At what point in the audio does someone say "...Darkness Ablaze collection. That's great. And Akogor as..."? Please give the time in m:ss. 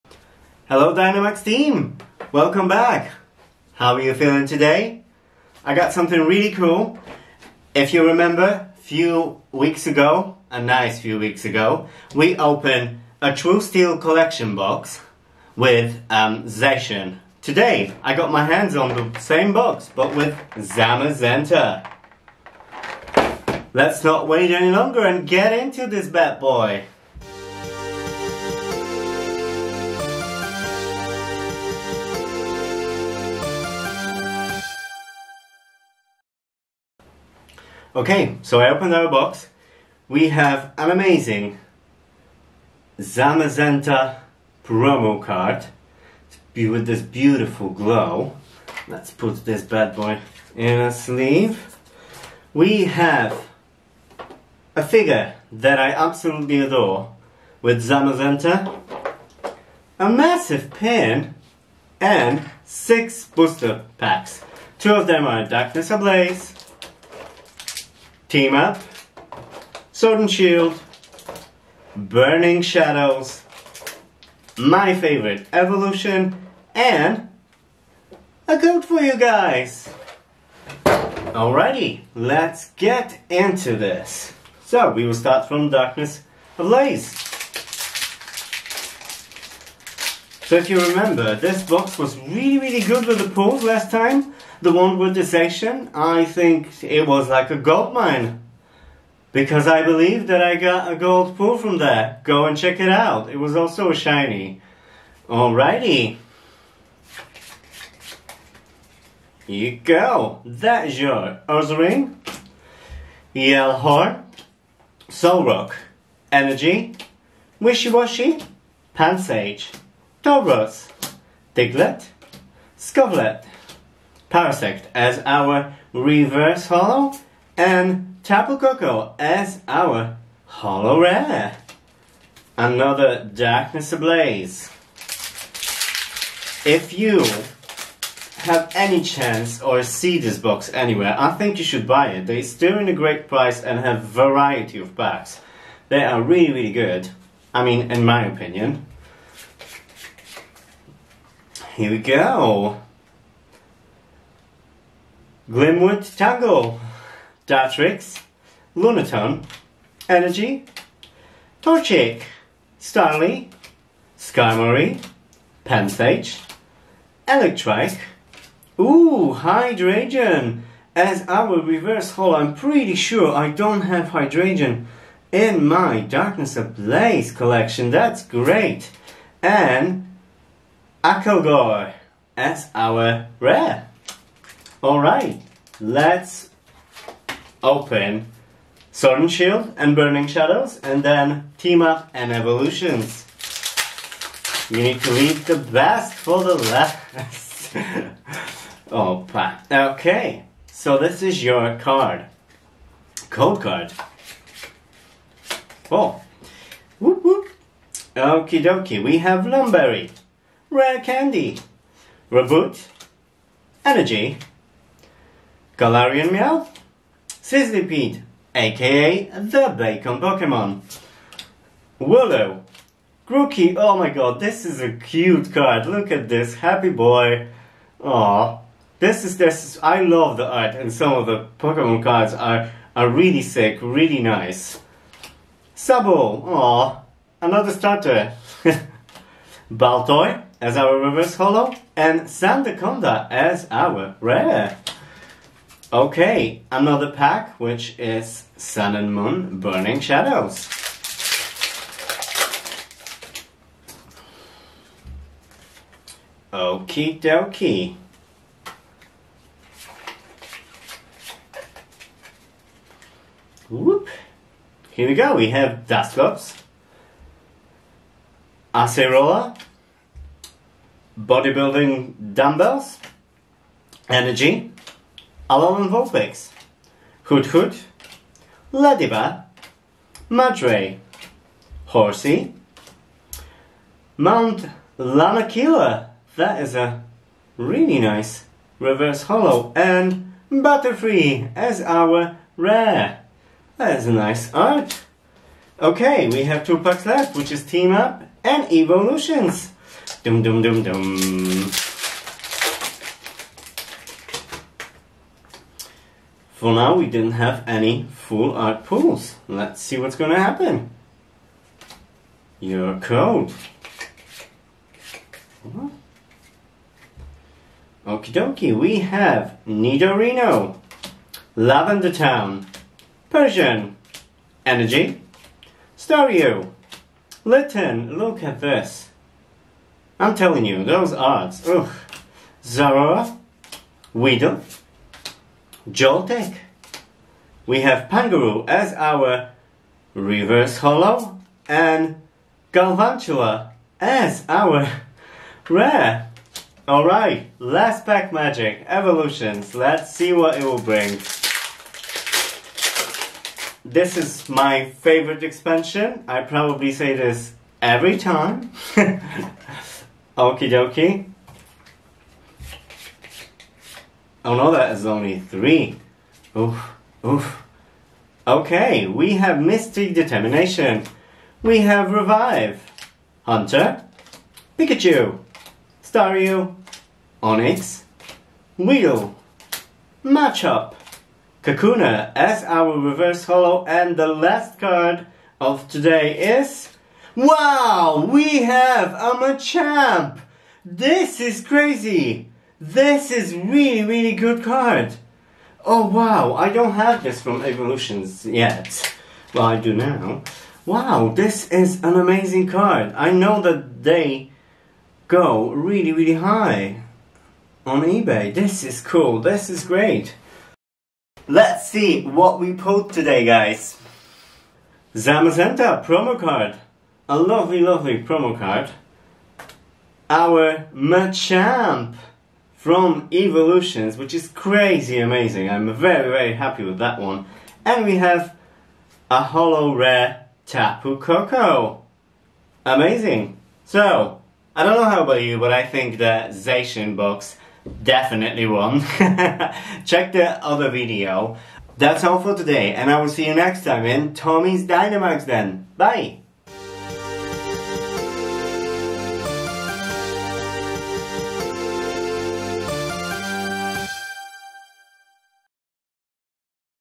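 2:56.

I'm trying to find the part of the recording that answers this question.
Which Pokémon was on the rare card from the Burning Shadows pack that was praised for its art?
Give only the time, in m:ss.
4:50.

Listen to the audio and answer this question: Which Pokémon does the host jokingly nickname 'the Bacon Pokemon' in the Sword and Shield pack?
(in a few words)
Sizzlipede.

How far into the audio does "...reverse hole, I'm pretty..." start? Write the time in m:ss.
2:51.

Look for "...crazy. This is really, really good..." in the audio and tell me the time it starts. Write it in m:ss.
6:31.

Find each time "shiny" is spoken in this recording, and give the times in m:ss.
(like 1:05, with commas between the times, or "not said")
1:43.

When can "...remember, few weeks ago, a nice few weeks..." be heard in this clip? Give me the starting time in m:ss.
0:08.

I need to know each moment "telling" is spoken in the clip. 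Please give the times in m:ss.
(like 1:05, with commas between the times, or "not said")
5:30.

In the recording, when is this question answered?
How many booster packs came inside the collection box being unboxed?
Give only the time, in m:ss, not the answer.
1:02.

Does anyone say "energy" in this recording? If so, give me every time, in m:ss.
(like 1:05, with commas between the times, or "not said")
1:56, 2:40, 3:33, 4:34, 5:24.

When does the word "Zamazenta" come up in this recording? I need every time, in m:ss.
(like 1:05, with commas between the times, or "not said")
0:20, 0:42, 0:57, 6:55.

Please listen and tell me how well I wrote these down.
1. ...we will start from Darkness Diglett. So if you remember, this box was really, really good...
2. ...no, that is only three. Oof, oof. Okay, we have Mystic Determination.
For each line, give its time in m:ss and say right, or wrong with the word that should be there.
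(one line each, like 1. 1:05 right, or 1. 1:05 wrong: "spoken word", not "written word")
1. 1:24 wrong: "Ablaze", not "Diglett"
2. 6:04 right.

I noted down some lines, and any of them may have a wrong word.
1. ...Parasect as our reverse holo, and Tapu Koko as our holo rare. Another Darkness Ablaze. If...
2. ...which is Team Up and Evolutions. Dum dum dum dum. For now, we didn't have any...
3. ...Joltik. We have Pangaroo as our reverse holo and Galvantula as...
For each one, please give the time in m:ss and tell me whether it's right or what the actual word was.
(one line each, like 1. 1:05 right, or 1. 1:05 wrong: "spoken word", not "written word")
1. 2:04 right
2. 4:57 right
3. 5:35 right.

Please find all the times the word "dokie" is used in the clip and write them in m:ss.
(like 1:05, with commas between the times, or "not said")
3:28, 4:17, 5:18, 6:00.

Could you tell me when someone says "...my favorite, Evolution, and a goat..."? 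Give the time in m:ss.
1:14.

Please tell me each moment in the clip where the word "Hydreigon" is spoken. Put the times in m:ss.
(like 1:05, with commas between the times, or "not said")
2:49, 2:54.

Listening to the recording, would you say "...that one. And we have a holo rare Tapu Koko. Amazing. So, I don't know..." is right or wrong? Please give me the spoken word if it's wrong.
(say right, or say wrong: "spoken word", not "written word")
right.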